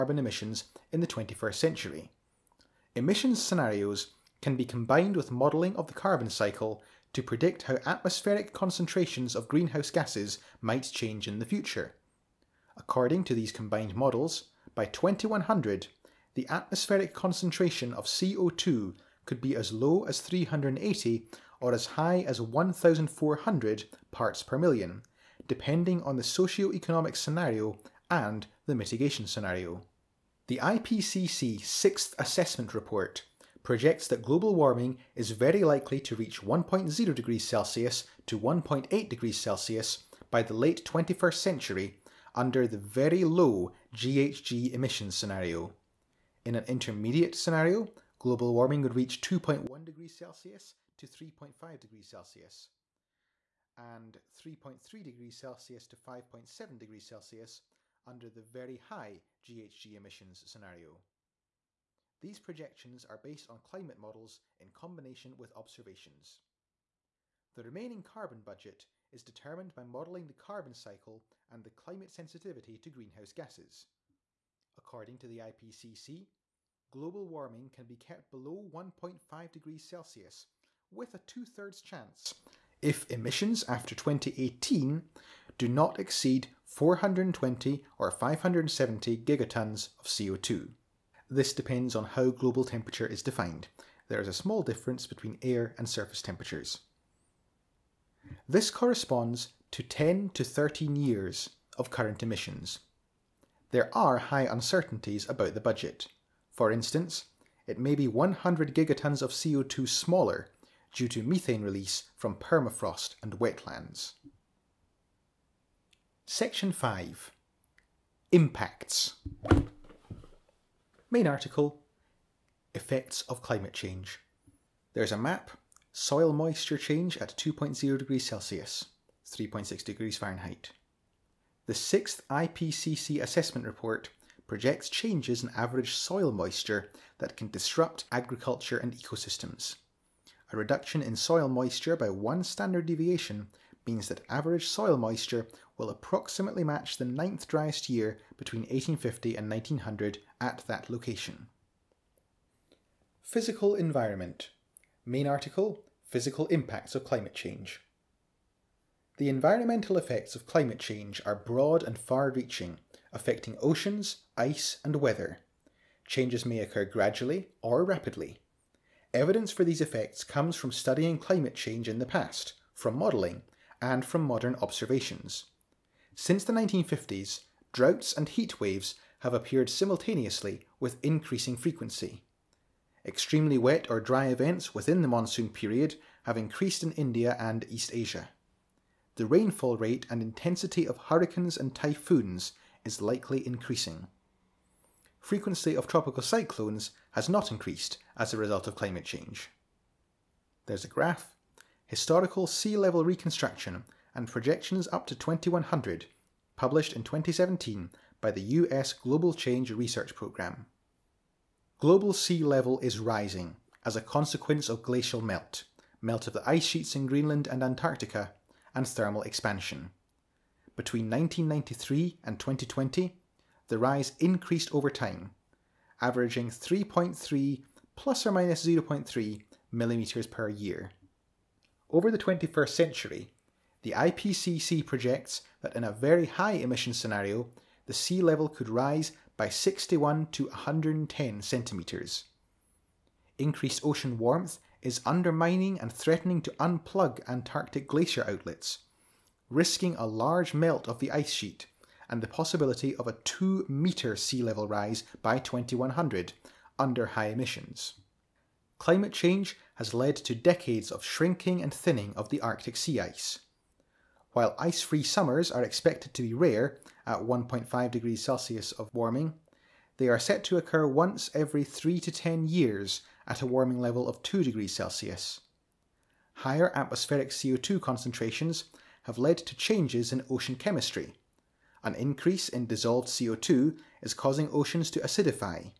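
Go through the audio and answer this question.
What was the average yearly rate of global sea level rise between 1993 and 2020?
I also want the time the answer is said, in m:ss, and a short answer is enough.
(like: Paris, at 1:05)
3.3 ± 0.3 mm per year, at 3:46.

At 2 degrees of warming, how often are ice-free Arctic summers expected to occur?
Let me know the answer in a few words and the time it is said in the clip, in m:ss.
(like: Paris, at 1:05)
Once every 3 to 10 years, at 4:30.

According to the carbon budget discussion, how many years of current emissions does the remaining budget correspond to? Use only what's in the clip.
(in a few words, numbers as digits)
10 to 13 years.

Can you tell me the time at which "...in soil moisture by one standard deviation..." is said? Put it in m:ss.
2:21.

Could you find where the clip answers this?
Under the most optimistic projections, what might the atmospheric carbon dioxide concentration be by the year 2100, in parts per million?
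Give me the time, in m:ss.
0:20.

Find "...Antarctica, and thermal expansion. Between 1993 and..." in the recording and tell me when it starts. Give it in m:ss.
3:37.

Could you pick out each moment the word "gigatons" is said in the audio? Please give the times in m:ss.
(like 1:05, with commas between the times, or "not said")
1:29, 1:48.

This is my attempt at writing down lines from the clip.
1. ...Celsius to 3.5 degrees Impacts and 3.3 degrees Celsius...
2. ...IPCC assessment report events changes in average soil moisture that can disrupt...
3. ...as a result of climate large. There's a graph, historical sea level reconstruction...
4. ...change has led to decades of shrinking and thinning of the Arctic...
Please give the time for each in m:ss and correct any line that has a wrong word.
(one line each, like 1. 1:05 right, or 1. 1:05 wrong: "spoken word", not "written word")
1. 0:50 wrong: "Celsius", not "Impacts"
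2. 2:12 wrong: "projects", not "events"
3. 3:18 wrong: "change", not "large"
4. 4:19 right.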